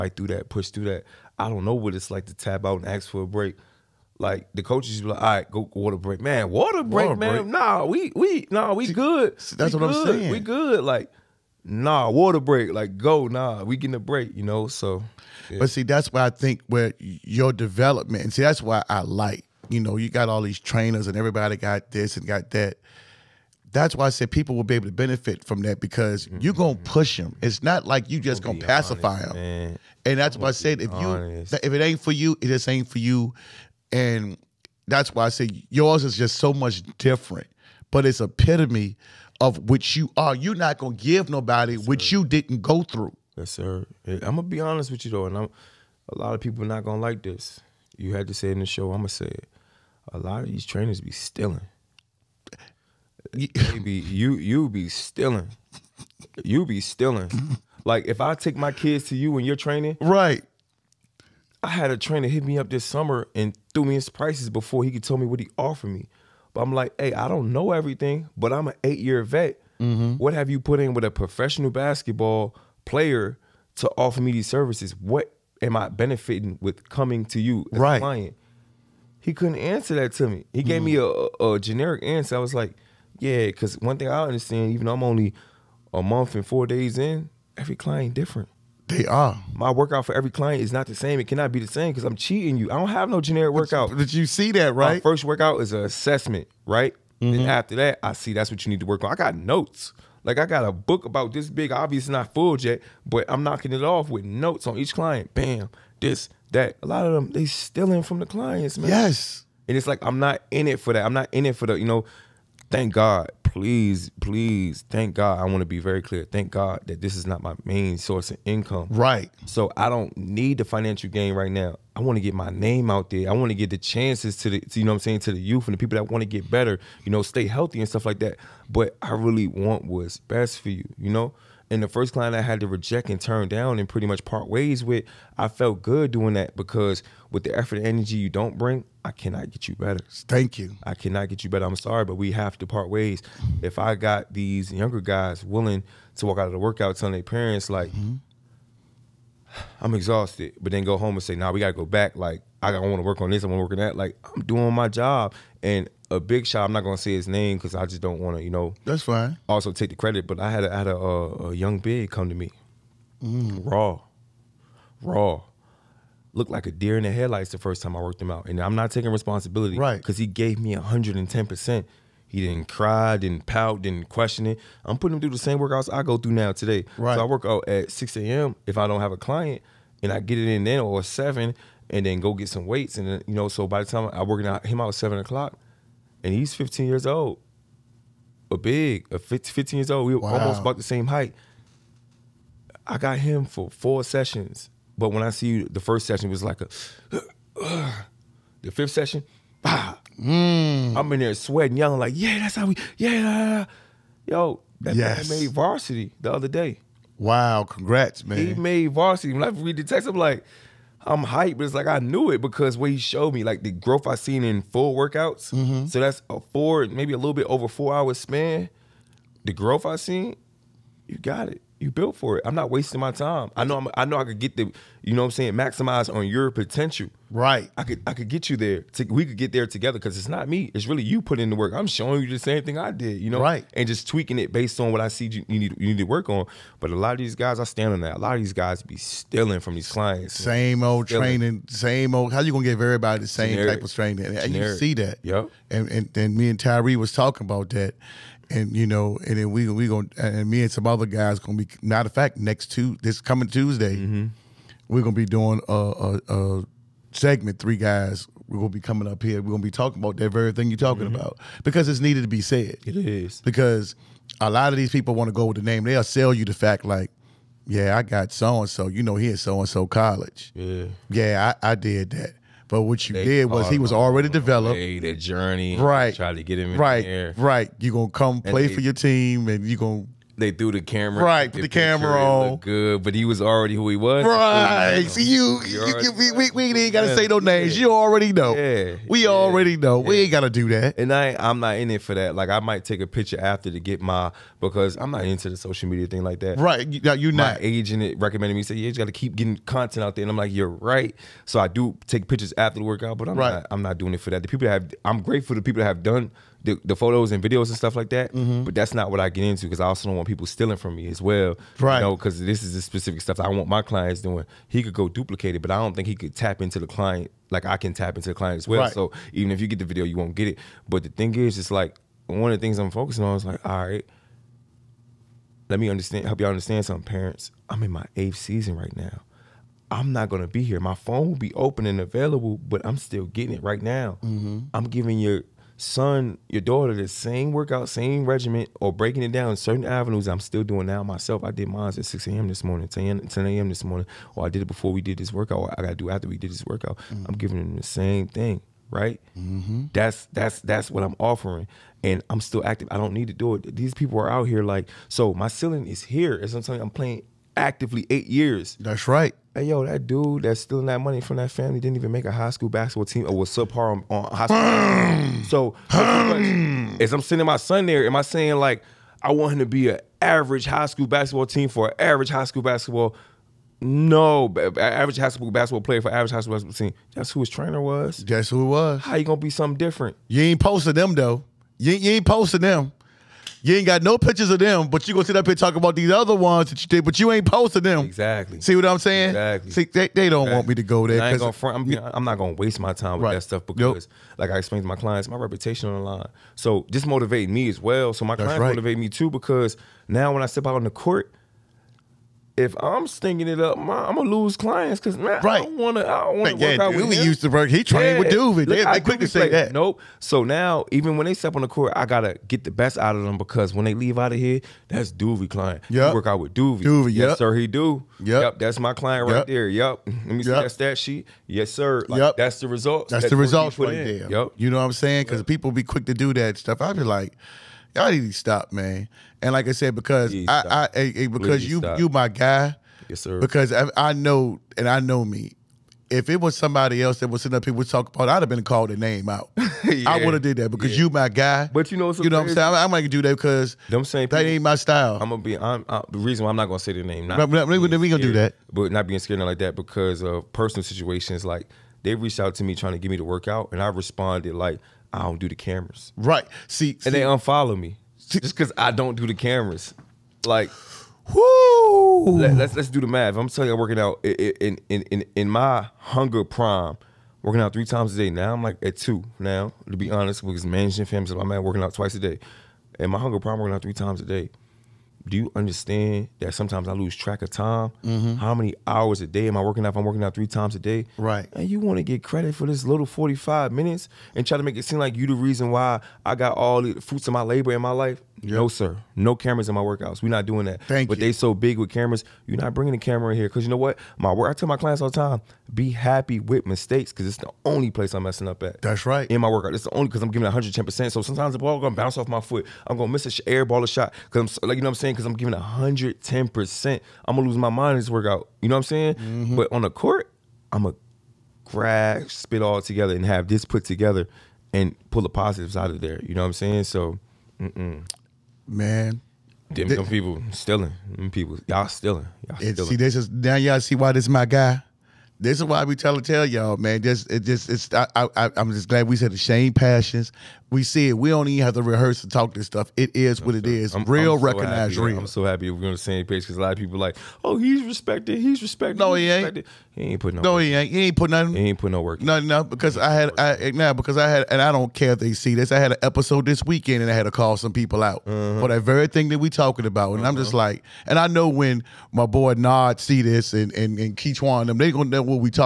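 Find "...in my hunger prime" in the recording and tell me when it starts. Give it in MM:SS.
07:45.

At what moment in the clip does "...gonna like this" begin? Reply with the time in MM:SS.
00:46.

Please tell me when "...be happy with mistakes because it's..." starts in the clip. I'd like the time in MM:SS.
08:15.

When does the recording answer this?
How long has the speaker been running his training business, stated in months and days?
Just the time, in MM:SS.
01:25.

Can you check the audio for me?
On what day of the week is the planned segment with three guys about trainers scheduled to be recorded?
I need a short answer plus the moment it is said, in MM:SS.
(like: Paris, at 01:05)
Tuesday, at 04:13.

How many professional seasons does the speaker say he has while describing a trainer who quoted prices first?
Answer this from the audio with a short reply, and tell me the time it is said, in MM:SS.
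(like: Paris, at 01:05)
8, at 01:08.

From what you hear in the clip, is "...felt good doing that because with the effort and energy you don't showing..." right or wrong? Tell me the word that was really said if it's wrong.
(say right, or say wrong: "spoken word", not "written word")
wrong: "bring", not "showing".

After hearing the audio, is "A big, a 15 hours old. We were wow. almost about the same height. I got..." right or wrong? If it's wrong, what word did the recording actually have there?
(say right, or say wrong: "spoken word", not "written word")
wrong: "years", not "hours".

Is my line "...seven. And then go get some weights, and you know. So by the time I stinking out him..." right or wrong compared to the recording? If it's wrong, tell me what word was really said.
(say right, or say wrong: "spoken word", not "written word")
wrong: "working", not "stinking".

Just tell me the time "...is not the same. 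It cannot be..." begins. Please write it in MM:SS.
01:30.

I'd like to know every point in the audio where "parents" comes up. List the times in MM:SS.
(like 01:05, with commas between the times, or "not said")
02:27, 05:27.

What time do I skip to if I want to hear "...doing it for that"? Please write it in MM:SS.
05:03.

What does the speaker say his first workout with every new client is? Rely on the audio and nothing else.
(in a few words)
An assessment.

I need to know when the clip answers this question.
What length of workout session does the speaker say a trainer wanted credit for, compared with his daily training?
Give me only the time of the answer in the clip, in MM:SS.
08:03.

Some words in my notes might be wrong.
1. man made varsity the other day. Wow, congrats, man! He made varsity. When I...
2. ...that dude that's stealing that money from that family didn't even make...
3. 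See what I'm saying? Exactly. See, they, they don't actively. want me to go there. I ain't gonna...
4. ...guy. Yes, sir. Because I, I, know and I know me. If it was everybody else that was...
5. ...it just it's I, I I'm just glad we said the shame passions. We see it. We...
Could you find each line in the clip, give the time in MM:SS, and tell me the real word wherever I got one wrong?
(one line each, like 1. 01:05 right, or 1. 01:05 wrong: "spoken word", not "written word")
1. 03:25 right
2. 05:59 right
3. 06:28 wrong: "exactly", not "actively"
4. 07:12 wrong: "somebody", not "everybody"
5. 08:47 right.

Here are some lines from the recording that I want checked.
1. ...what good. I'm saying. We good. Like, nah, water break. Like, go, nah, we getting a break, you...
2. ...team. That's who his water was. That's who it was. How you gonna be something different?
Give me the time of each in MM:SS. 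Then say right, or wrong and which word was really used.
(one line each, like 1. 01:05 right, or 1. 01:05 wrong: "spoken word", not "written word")
1. 00:09 right
2. 06:16 wrong: "trainer", not "water".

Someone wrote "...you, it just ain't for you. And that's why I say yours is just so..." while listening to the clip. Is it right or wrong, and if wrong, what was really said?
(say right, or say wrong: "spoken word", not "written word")
right.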